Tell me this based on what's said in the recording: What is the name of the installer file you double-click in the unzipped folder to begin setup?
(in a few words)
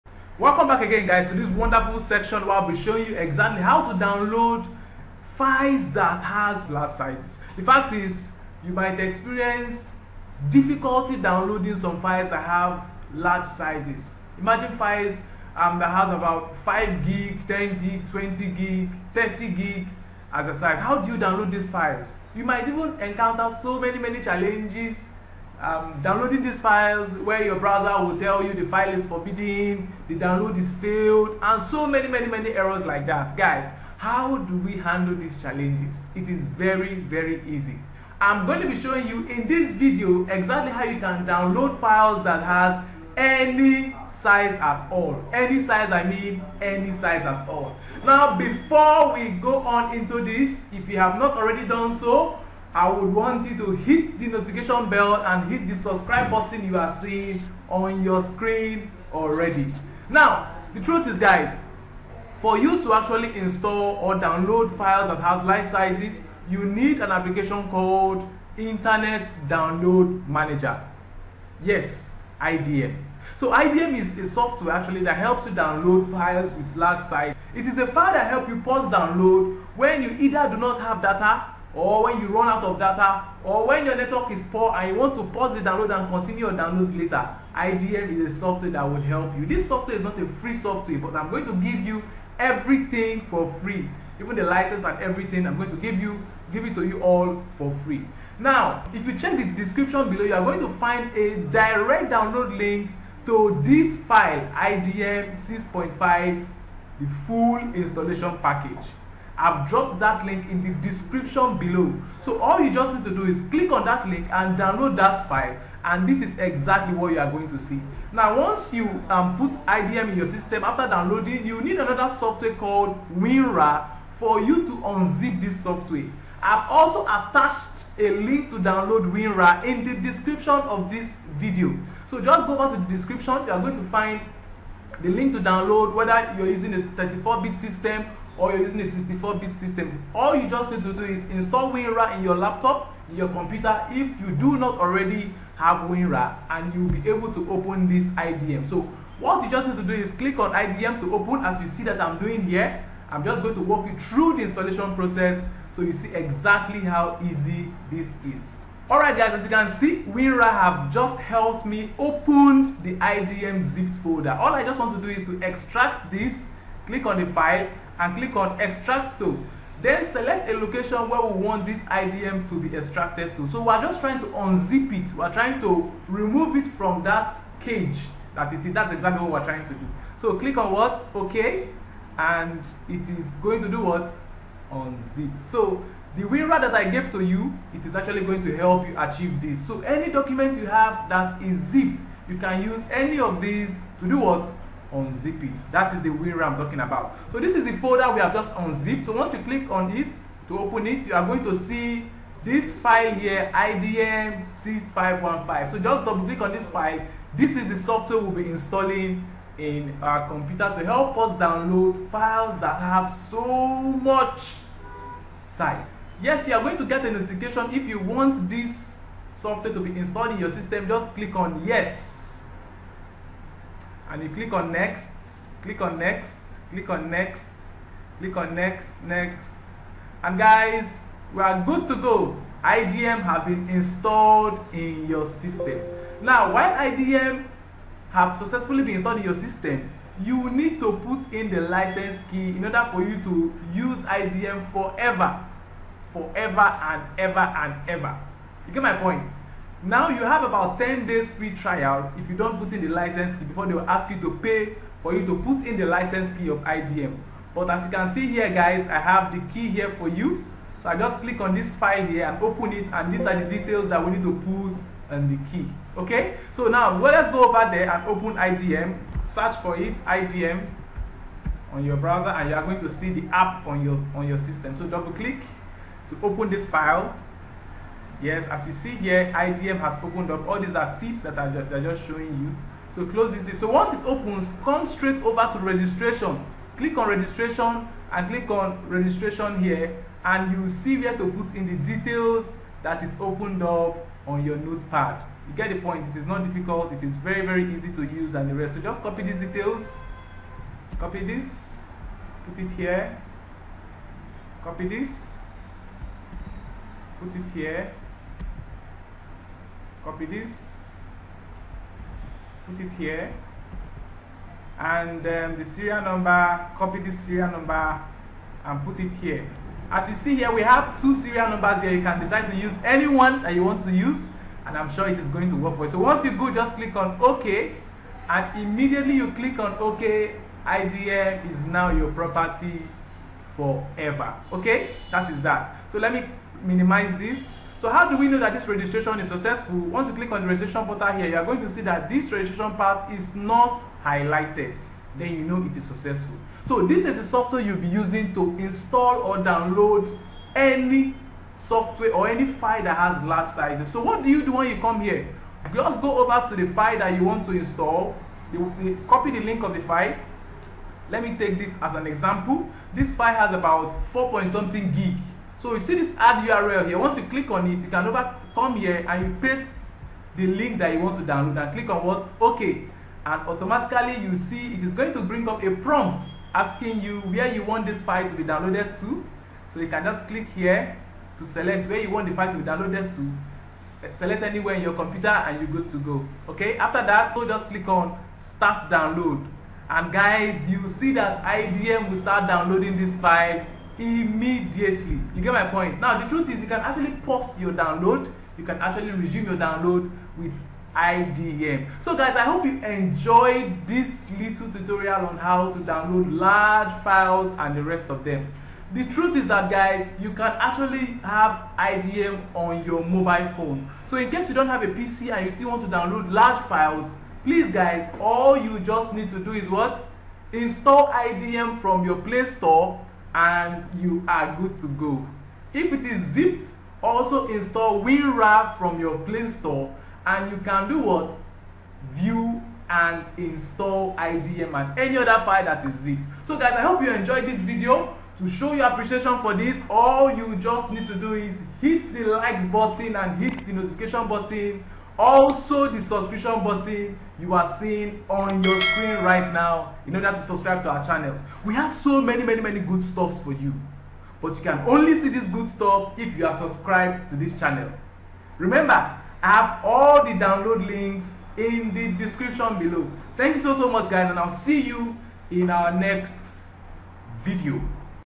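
IDM 6515.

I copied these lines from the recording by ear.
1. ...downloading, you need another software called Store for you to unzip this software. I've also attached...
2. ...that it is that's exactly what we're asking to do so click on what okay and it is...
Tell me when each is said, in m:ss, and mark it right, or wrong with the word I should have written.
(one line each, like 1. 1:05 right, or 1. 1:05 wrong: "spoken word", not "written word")
1. 2:00 wrong: "WinRAR", not "Store"
2. 2:58 wrong: "trying", not "asking".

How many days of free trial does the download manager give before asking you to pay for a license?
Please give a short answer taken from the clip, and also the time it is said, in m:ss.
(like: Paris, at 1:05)
10 days, at 4:10.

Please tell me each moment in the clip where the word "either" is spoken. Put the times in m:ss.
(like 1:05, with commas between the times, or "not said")
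1:20.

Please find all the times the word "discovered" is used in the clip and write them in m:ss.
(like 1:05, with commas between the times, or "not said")
not said.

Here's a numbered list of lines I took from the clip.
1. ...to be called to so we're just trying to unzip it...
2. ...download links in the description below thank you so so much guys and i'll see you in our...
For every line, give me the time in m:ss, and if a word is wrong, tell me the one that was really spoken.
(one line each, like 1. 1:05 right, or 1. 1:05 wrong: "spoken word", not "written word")
1. 2:52 wrong: "extracted", not "called"
2. 7:40 right.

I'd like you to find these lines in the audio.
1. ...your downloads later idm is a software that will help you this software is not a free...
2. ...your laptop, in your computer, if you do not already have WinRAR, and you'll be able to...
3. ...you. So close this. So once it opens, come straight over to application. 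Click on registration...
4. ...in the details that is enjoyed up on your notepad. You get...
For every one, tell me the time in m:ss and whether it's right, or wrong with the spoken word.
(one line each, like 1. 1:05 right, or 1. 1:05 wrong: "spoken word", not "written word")
1. 1:26 right
2. 2:22 right
3. 4:42 wrong: "registration", not "application"
4. 4:51 wrong: "opened", not "enjoyed".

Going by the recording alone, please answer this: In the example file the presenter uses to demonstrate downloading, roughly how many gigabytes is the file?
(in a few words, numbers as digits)
4.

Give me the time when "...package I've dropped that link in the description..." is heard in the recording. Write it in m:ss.
1:48.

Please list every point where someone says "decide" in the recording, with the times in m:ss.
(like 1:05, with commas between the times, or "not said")
5:22.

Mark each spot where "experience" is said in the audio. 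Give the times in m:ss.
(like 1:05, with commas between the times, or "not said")
0:08.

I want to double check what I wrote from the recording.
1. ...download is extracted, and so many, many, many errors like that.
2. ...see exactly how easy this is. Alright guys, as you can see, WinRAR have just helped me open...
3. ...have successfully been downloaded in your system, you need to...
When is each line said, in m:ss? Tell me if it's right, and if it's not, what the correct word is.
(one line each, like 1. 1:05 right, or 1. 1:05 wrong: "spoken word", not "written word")
1. 0:30 wrong: "failed", not "extracted"
2. 2:35 right
3. 3:58 wrong: "installed", not "downloaded".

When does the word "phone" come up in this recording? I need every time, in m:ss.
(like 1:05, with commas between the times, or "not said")
6:53.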